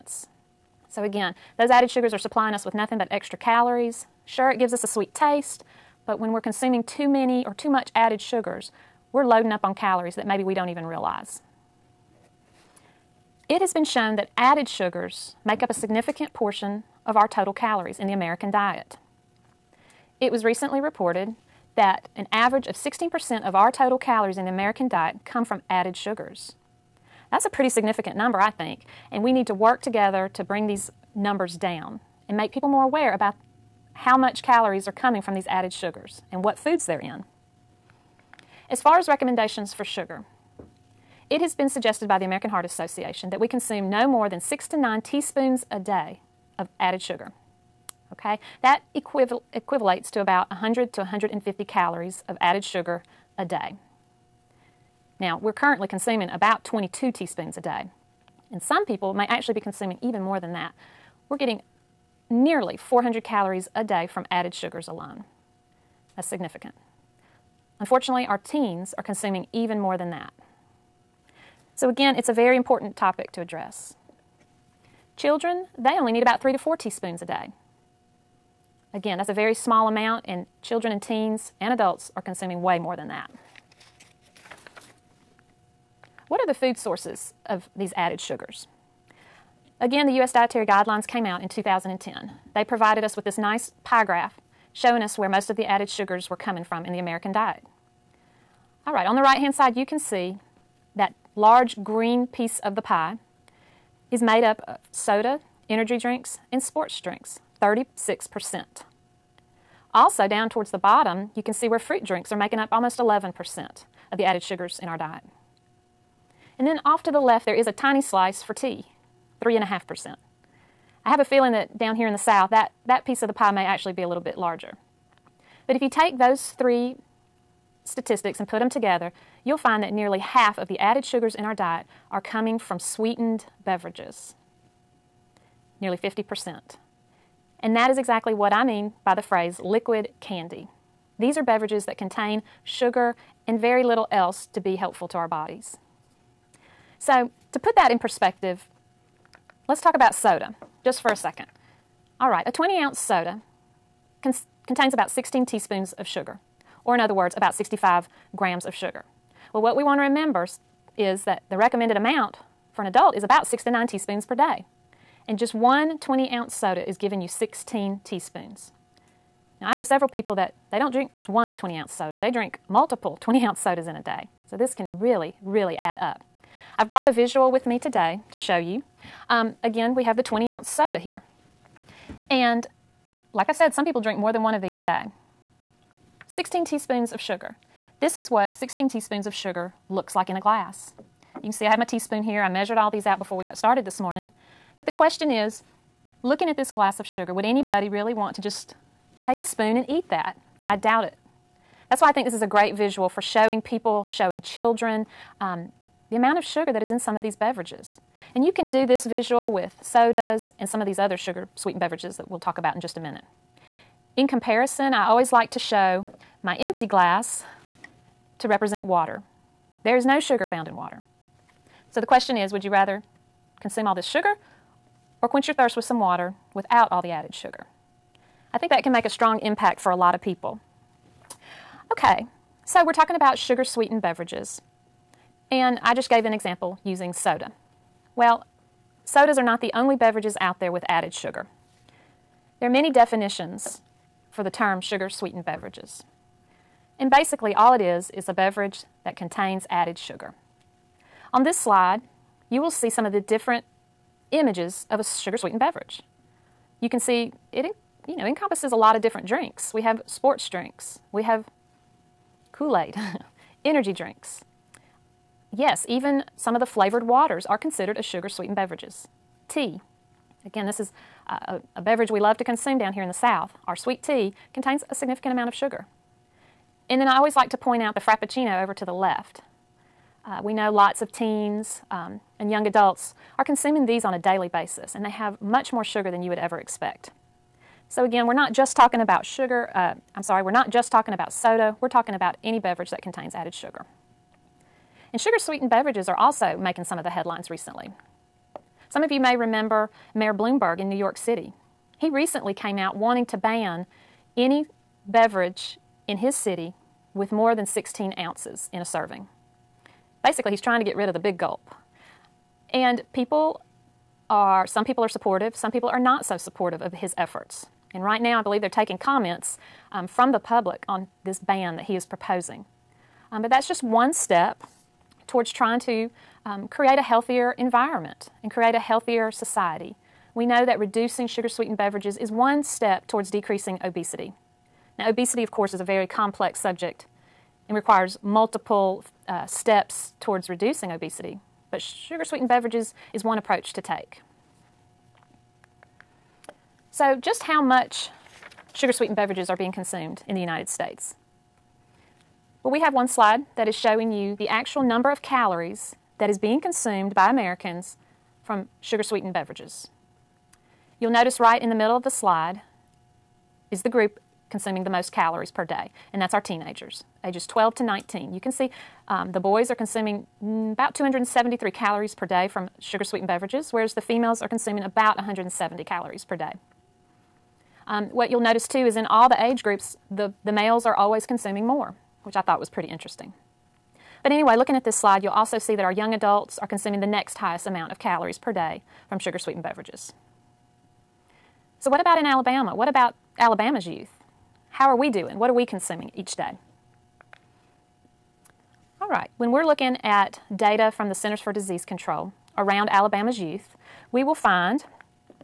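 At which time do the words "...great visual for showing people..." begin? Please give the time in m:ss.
3:22.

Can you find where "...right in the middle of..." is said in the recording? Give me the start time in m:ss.
6:01.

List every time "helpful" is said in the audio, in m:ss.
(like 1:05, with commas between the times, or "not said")
2:24.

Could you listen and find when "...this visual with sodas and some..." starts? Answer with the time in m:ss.
3:28.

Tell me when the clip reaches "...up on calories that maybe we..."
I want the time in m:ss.
0:09.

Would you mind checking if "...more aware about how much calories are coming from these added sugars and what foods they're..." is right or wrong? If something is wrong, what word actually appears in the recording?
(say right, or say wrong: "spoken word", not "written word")
right.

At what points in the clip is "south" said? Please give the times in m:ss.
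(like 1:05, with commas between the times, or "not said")
2:02, 4:33.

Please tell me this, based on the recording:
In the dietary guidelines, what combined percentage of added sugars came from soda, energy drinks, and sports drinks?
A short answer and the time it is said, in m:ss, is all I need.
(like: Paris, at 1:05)
36%, at 1:47.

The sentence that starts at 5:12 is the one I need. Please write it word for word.
And people are, some people are supportive, some people are not so supportive of his efforts.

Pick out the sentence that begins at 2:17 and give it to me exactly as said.
And that is exactly what I mean by the phrase liquid candy.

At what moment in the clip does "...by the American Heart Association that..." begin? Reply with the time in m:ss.
0:42.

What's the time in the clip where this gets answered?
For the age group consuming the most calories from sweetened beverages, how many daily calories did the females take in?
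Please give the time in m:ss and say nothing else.
6:15.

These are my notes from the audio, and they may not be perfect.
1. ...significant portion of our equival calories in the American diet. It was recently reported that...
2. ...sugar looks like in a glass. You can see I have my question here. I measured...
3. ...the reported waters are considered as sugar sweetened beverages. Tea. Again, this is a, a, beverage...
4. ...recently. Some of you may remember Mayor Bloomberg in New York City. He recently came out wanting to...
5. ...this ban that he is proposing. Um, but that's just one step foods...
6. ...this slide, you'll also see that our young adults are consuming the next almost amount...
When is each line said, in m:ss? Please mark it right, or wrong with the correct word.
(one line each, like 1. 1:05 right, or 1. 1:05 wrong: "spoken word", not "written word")
1. 0:15 wrong: "total", not "equival"
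2. 3:09 wrong: "teaspoon", not "question"
3. 4:26 wrong: "flavored", not "reported"
4. 4:57 right
5. 5:21 wrong: "towards", not "foods"
6. 6:24 wrong: "highest", not "almost".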